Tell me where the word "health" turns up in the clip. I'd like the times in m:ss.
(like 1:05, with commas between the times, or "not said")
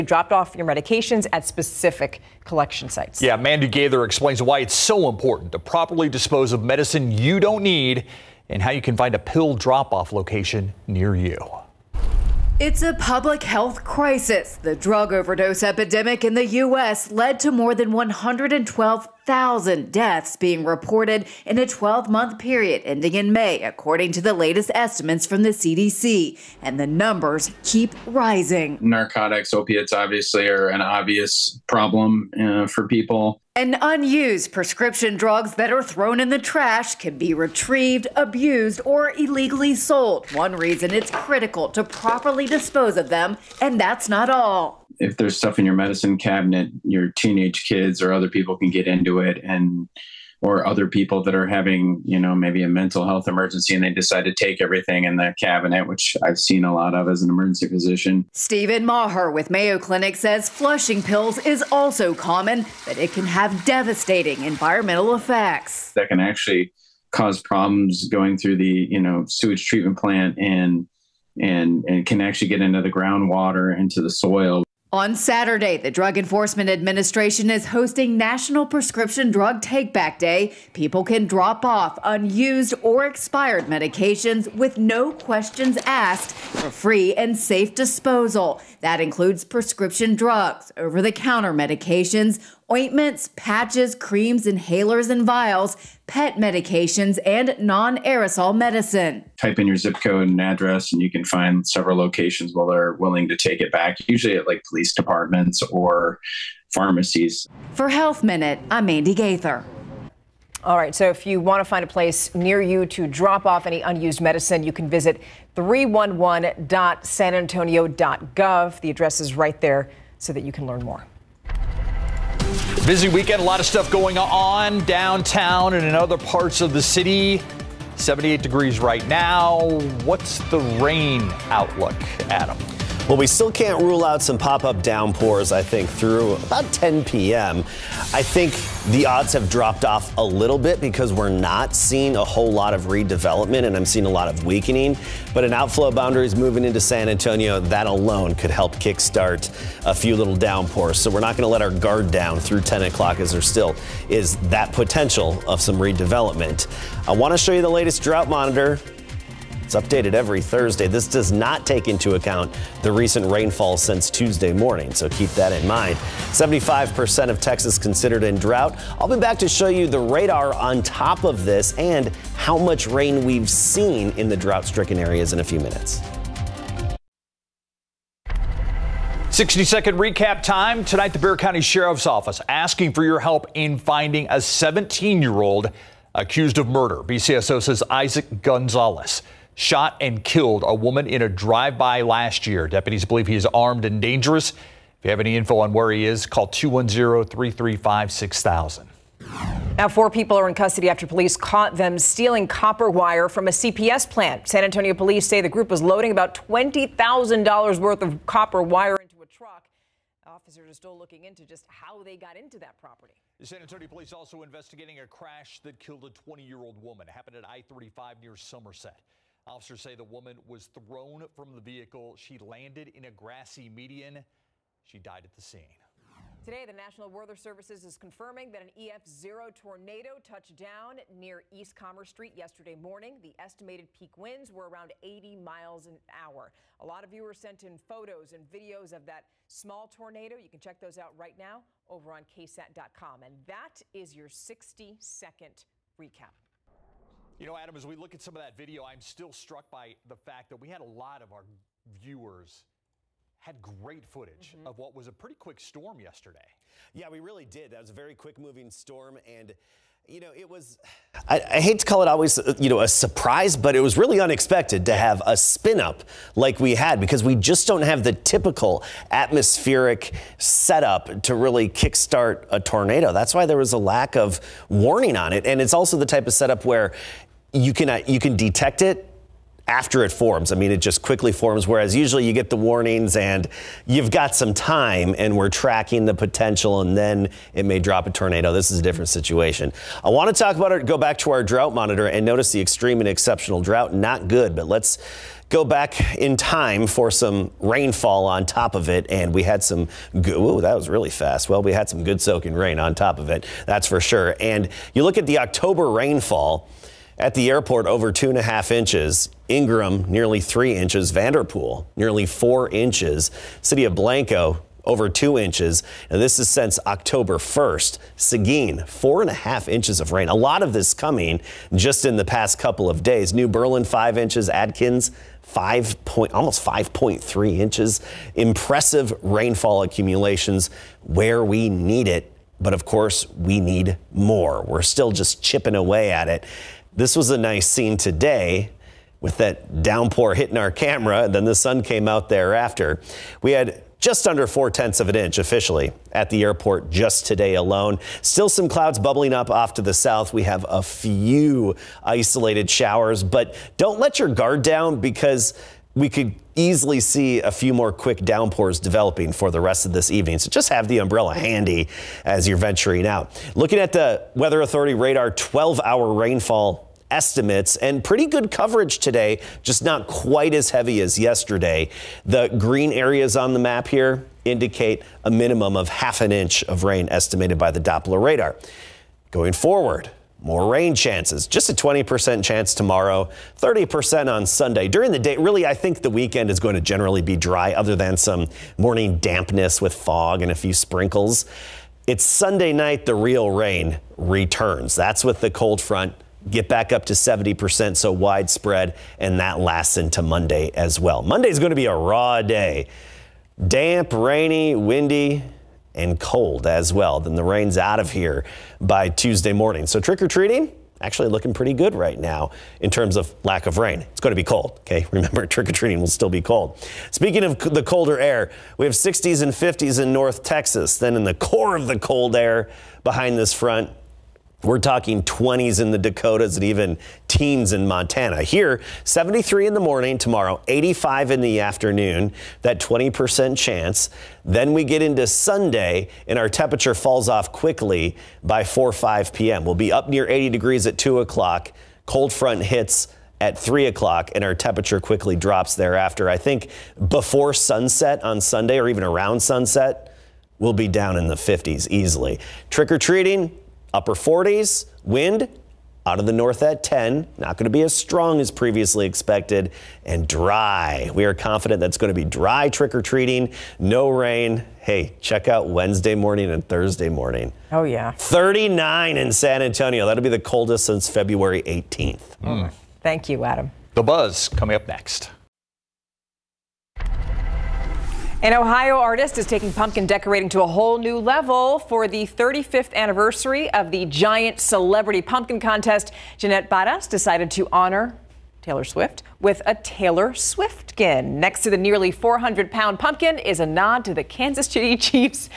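0:13, 0:53, 1:47.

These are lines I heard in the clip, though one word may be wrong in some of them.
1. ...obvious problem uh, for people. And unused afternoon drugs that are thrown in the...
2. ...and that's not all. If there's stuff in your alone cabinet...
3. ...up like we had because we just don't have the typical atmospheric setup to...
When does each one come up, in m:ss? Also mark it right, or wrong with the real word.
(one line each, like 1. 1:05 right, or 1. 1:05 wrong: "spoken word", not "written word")
1. 0:30 wrong: "prescription", not "afternoon"
2. 0:43 wrong: "medicine", not "alone"
3. 4:25 right.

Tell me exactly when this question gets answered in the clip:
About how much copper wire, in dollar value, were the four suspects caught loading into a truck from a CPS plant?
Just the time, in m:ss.
3:26.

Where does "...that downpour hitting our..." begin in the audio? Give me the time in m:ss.
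5:39.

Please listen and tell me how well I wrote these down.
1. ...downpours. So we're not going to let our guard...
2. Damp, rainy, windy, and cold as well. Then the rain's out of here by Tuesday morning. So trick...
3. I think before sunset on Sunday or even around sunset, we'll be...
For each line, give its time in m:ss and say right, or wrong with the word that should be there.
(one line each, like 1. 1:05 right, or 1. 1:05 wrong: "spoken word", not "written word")
1. 2:30 right
2. 6:43 right
3. 7:26 right.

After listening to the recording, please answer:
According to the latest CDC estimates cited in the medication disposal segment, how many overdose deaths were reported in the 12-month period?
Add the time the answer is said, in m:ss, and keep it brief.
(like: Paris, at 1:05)
112,000, at 0:17.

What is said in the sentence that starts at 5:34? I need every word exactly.
We're still just chipping away at it.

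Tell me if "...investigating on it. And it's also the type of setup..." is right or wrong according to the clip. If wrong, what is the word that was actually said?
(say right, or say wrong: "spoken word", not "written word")
wrong: "warning", not "investigating".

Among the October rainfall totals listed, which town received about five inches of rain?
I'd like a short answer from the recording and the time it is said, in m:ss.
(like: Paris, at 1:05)
New Berlin, at 5:23.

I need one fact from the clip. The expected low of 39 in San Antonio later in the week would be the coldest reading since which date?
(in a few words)
February 18th.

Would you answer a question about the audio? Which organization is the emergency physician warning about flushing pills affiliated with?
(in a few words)
Mayo Clinic.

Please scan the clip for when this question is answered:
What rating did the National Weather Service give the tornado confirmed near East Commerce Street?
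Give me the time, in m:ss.
3:48.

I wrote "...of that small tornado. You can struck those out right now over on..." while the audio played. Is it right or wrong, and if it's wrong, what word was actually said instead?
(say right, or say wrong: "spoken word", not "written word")
wrong: "check", not "struck".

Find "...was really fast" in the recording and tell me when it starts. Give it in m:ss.
5:00.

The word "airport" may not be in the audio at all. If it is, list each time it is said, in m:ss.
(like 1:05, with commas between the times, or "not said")
5:07, 5:46.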